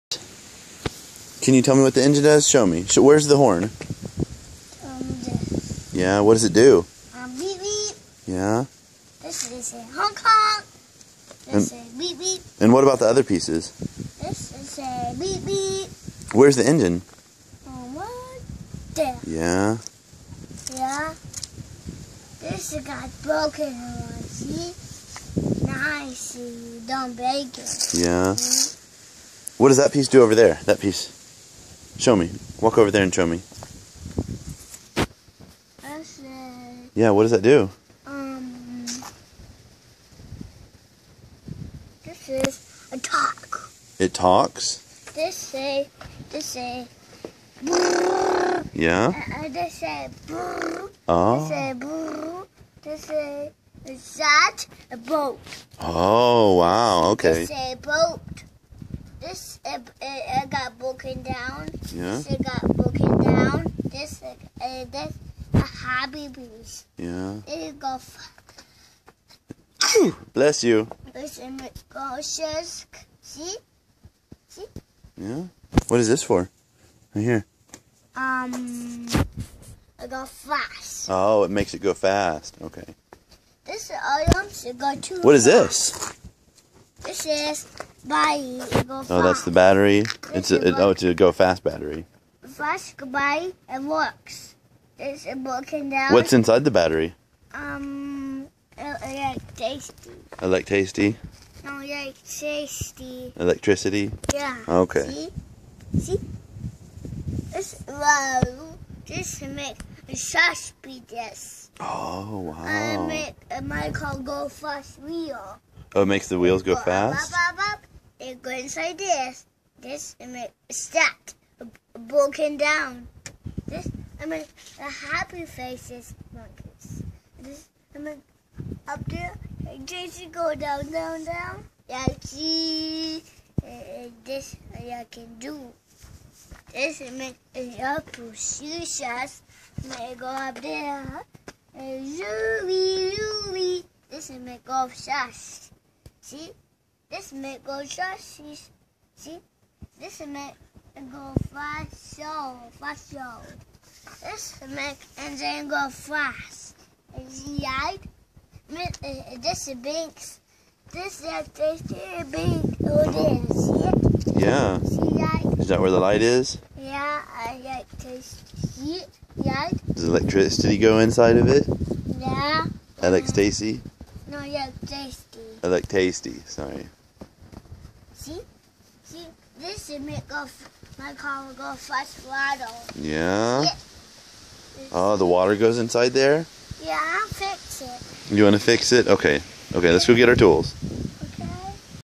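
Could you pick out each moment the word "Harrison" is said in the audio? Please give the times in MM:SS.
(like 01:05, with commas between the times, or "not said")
not said.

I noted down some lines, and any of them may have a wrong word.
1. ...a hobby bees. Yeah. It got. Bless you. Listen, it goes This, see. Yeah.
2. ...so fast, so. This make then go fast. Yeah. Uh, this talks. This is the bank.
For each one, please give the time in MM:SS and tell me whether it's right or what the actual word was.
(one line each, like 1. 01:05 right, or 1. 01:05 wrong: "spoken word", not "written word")
1. 01:05 wrong: "See", not "This"
2. 02:32 wrong: "banks", not "talks".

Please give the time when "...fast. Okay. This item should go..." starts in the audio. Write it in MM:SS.
01:21.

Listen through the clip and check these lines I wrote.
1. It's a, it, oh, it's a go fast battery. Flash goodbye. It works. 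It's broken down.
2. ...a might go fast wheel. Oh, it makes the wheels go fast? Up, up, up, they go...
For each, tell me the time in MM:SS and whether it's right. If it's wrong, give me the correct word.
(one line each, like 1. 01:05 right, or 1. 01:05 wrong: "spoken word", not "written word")
1. 01:30 right
2. 01:53 right.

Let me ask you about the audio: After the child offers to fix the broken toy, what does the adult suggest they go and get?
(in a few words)
tools.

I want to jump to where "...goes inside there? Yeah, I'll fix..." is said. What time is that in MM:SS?
03:05.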